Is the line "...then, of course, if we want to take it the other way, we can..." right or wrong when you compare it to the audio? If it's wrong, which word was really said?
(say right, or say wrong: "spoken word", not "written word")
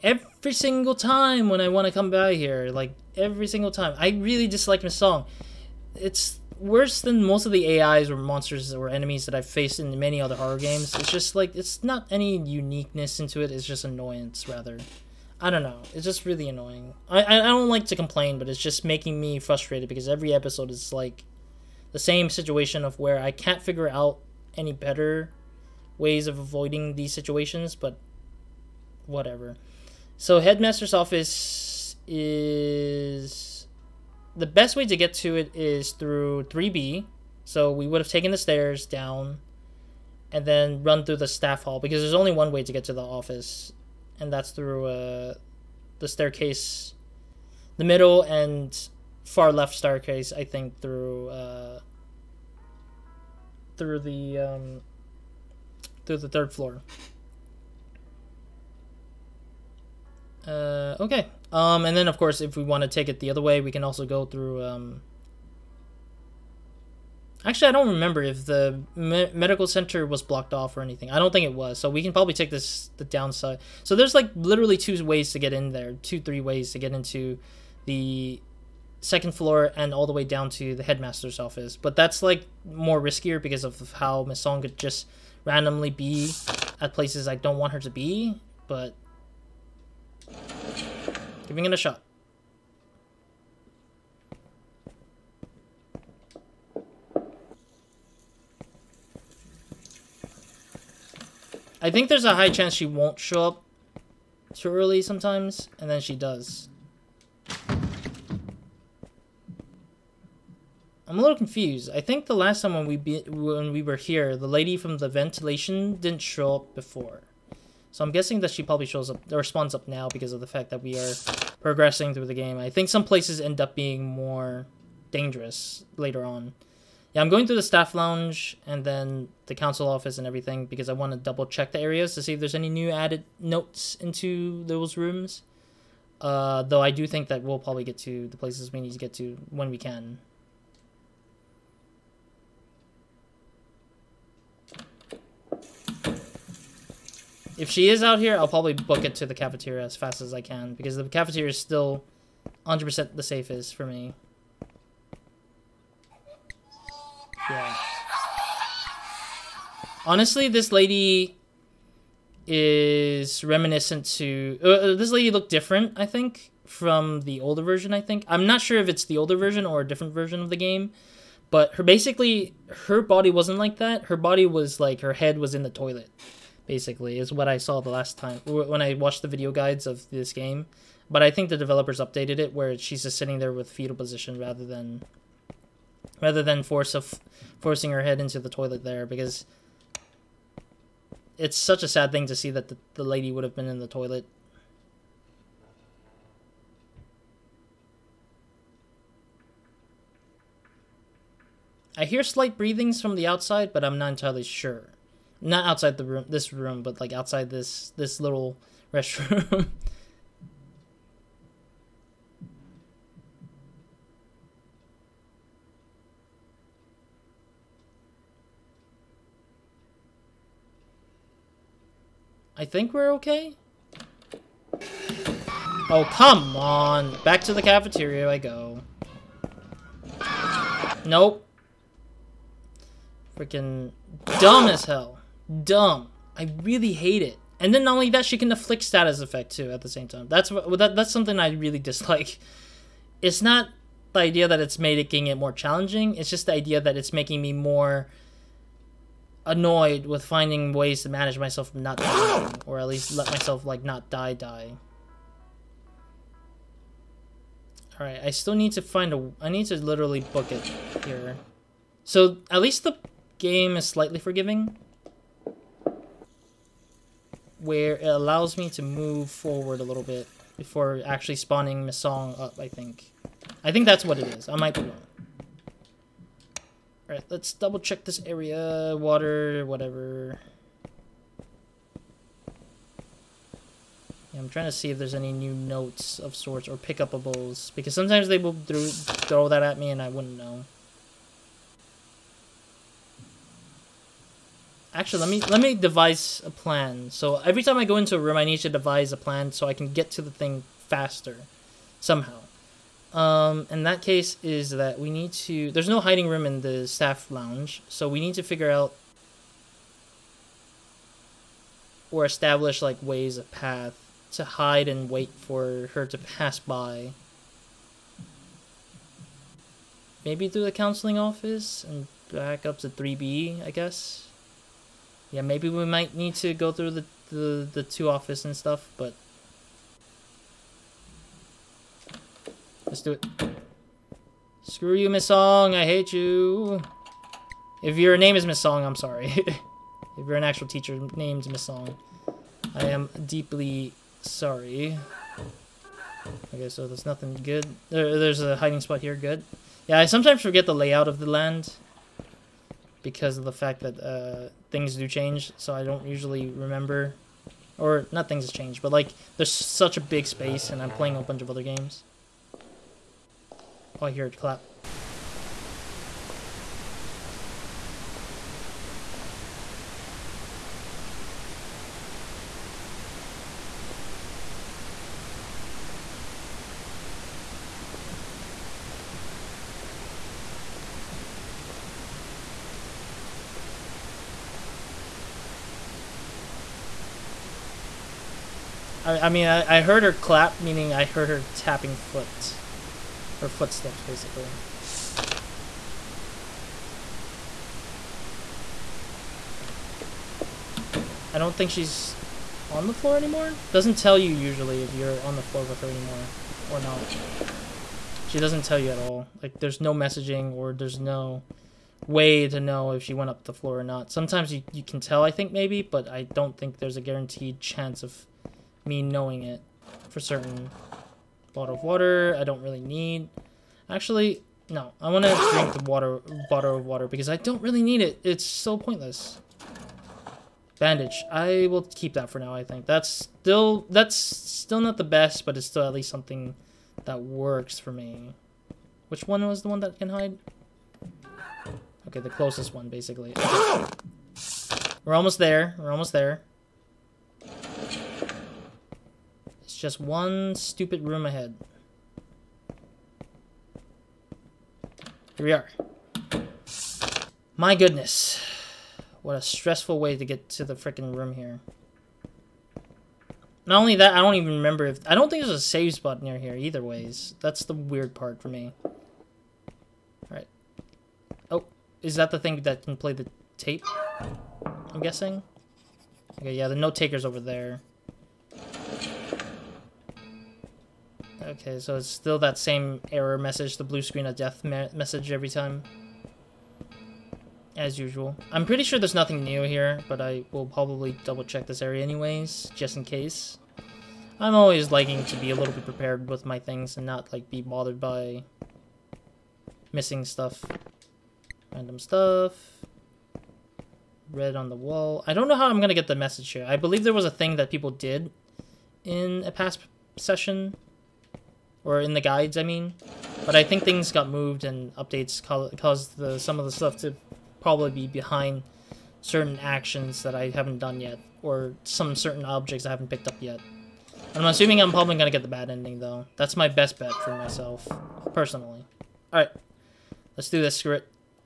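right.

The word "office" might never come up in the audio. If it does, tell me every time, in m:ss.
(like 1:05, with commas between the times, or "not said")
0:30, 0:43, 1:21, 2:09, 5:21, 5:28.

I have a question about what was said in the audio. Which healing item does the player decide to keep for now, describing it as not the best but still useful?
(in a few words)
Bandage.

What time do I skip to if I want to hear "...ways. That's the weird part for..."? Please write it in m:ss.
7:46.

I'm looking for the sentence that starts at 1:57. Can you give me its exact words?
So I'm guessing that she probably shows up or up now because of the fact that we are progressing through the game.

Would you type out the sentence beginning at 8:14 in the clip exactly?
I'm always liking to be a little bit prepared with my things and not like be bothered by missing stuff.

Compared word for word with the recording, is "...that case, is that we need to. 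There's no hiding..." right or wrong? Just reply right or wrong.
right.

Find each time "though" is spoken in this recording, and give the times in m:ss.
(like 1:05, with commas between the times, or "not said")
2:16, 8:46.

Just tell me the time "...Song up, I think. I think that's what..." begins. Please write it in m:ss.
4:31.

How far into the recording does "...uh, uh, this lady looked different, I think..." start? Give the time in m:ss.
2:44.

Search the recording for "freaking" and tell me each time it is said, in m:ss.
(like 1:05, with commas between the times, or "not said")
3:53, 7:40.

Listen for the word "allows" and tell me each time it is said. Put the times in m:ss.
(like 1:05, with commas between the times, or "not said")
4:28.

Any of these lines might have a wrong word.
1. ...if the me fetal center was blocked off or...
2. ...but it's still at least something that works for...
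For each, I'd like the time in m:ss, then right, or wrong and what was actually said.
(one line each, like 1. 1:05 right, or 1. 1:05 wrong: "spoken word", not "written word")
1. 1:08 wrong: "medical", not "fetal"
2. 7:15 right.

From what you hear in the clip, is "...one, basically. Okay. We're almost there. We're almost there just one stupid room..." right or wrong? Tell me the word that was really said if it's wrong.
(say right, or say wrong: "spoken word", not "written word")
right.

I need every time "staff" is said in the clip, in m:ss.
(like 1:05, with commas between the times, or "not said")
0:41, 2:07, 5:06.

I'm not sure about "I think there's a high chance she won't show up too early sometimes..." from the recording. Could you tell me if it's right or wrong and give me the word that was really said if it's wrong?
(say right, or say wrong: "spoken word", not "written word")
right.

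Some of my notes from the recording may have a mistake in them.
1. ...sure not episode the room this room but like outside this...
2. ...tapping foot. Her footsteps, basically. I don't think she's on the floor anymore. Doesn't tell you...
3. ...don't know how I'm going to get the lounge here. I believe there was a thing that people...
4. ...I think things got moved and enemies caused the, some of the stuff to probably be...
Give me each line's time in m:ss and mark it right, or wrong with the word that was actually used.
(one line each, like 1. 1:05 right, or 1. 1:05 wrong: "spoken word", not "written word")
1. 3:24 wrong: "outside", not "episode"
2. 6:31 right
3. 8:25 wrong: "message", not "lounge"
4. 8:33 wrong: "updates", not "enemies".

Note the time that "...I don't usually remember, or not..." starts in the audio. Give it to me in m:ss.
5:55.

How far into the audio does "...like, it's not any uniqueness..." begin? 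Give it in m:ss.
0:11.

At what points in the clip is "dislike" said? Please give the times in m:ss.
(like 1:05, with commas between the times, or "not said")
0:04, 4:01.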